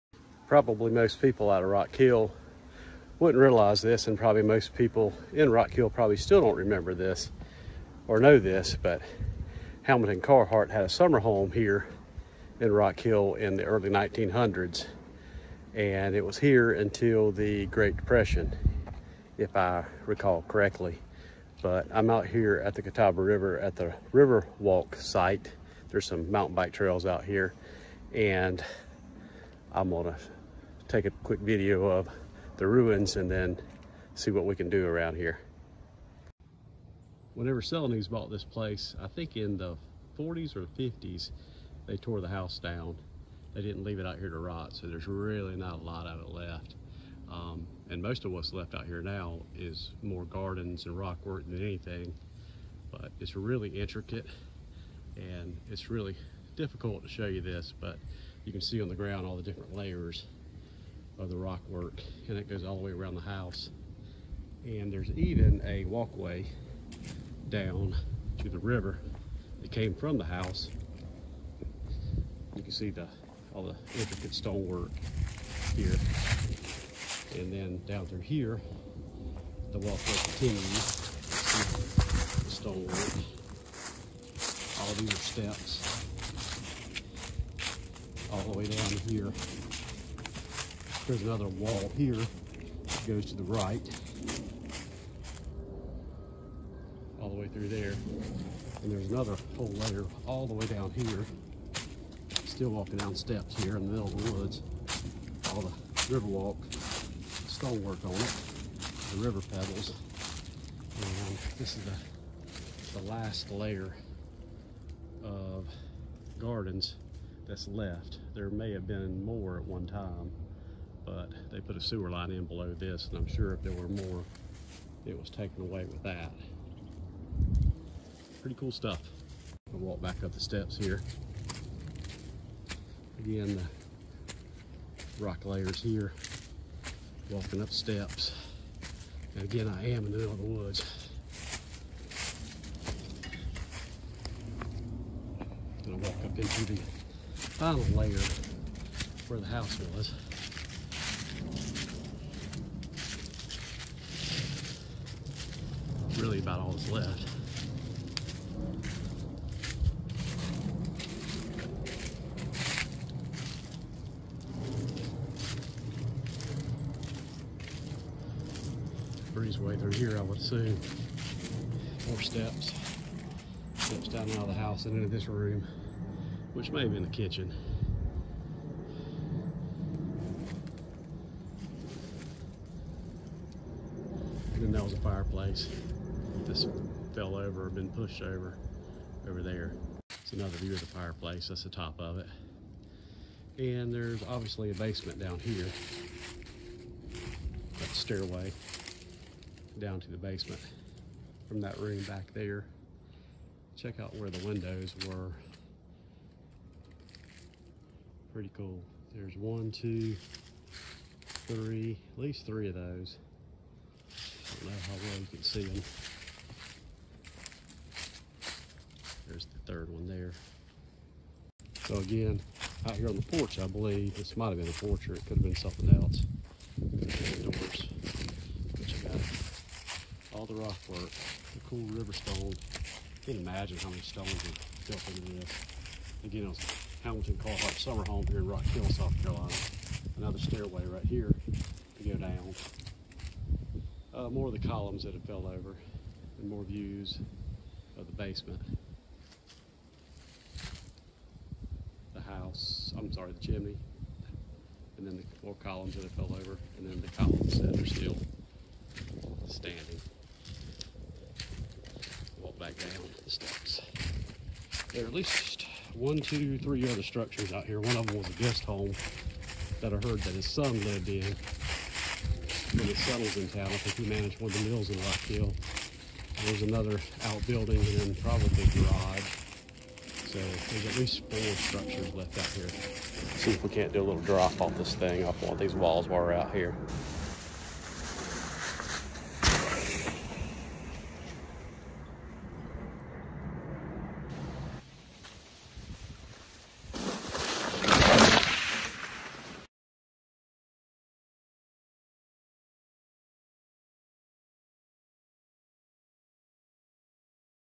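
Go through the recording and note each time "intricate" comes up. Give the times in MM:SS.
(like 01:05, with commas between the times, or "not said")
00:53, 01:13.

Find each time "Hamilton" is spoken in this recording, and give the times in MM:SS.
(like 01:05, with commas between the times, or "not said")
00:09, 03:57.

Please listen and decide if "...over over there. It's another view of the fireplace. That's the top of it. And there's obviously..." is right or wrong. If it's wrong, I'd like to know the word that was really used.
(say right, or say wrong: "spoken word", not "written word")
right.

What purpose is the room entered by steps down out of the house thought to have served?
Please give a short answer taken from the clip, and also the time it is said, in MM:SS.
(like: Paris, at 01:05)
Kitchen, at 02:57.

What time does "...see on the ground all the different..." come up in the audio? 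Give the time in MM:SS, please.
00:58.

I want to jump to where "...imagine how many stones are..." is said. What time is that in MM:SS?
03:53.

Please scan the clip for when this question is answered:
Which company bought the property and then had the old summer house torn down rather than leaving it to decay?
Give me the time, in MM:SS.
00:37.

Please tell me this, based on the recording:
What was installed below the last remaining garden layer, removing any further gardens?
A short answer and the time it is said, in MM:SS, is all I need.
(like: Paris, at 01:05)
A sewer line, at 02:01.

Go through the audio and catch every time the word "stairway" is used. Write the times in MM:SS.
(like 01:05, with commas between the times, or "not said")
03:17, 04:00.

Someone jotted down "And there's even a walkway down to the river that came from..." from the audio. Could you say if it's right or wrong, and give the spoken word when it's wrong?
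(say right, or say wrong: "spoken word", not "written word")
right.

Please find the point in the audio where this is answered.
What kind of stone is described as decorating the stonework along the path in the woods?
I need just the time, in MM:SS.
01:49.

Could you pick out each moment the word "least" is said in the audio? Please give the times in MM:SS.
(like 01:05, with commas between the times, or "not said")
03:32, 04:25, 04:40.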